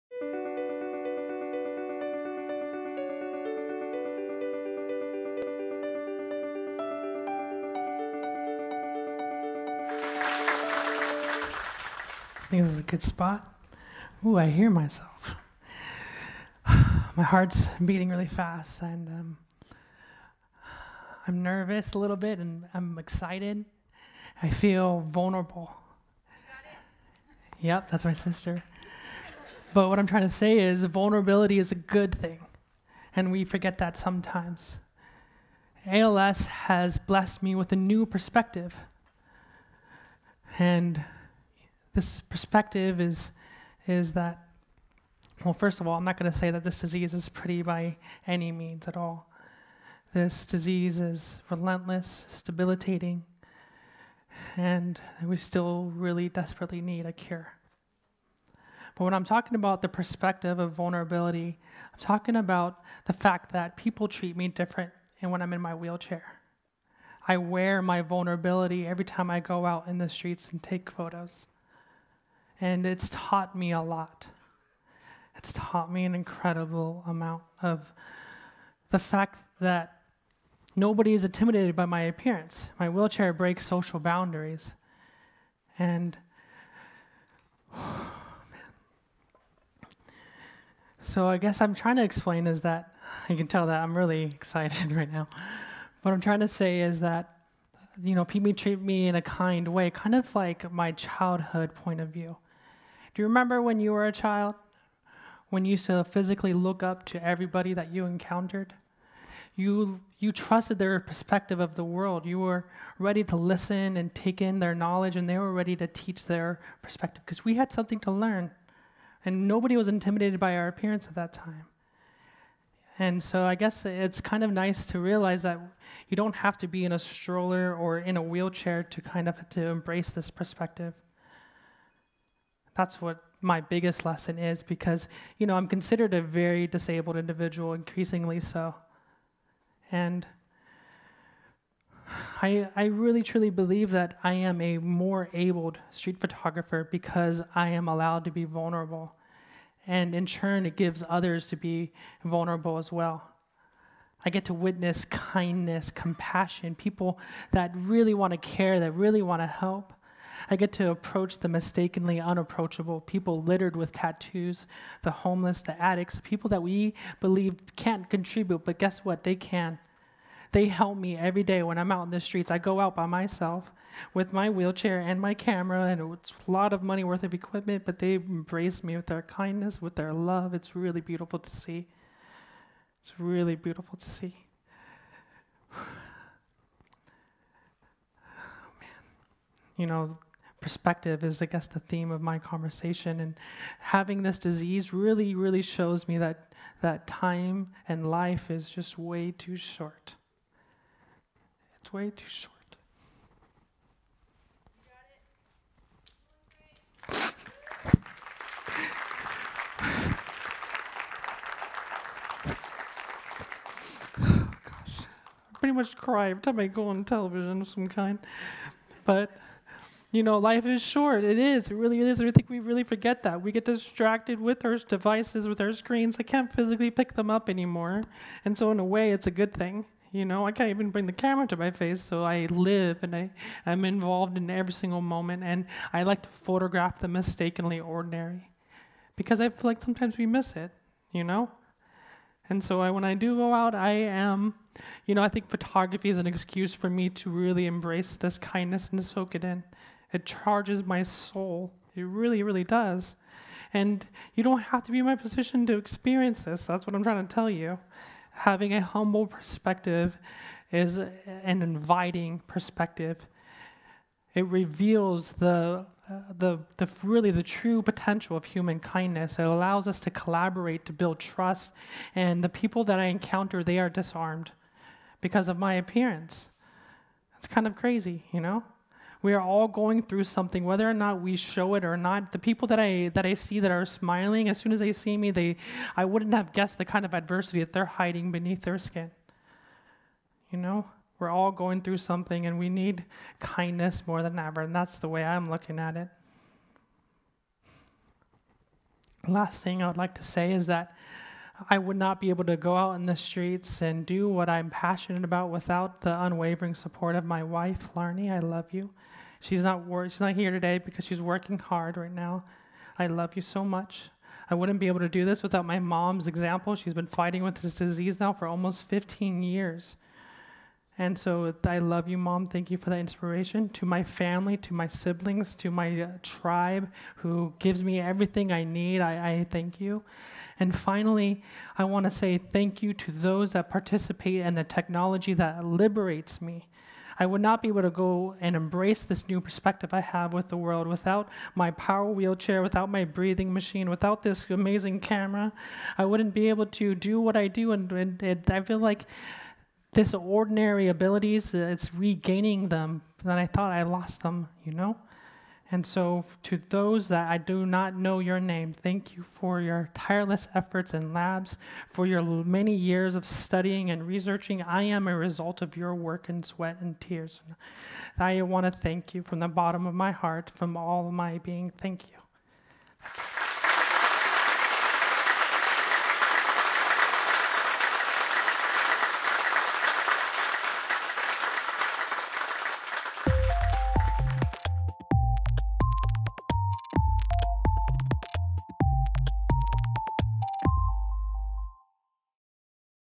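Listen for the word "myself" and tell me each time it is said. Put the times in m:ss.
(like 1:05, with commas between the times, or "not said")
0:14, 2:53.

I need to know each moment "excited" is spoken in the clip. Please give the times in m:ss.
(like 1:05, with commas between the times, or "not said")
0:22, 1:34.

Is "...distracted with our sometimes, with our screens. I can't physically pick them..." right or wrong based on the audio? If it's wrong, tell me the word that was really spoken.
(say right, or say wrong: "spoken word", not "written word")
wrong: "devices", not "sometimes".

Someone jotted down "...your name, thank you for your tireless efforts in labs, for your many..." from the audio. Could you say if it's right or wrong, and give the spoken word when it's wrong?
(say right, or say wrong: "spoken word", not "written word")
right.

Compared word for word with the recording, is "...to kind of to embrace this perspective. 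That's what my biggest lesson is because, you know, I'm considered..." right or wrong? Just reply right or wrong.
right.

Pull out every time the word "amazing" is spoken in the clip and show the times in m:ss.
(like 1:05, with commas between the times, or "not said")
5:44.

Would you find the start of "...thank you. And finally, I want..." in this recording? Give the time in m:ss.
5:29.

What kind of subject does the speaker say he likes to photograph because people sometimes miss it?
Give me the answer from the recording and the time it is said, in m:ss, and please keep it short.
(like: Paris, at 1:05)
The mistakenly ordinary, at 3:57.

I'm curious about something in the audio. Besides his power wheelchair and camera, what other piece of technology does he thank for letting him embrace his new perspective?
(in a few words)
Breathing machine.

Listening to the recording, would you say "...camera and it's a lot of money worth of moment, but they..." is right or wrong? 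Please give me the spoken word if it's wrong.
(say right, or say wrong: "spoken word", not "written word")
wrong: "equipment", not "moment".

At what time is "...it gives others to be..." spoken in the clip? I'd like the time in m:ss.
2:30.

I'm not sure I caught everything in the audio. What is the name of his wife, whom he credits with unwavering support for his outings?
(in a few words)
Larnie.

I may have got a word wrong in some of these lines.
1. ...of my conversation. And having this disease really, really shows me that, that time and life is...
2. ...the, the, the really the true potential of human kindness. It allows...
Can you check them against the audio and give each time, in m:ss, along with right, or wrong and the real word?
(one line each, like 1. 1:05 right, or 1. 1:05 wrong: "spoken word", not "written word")
1. 3:12 right
2. 4:25 right.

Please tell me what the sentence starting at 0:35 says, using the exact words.
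ALS has blessed me with a new perspective.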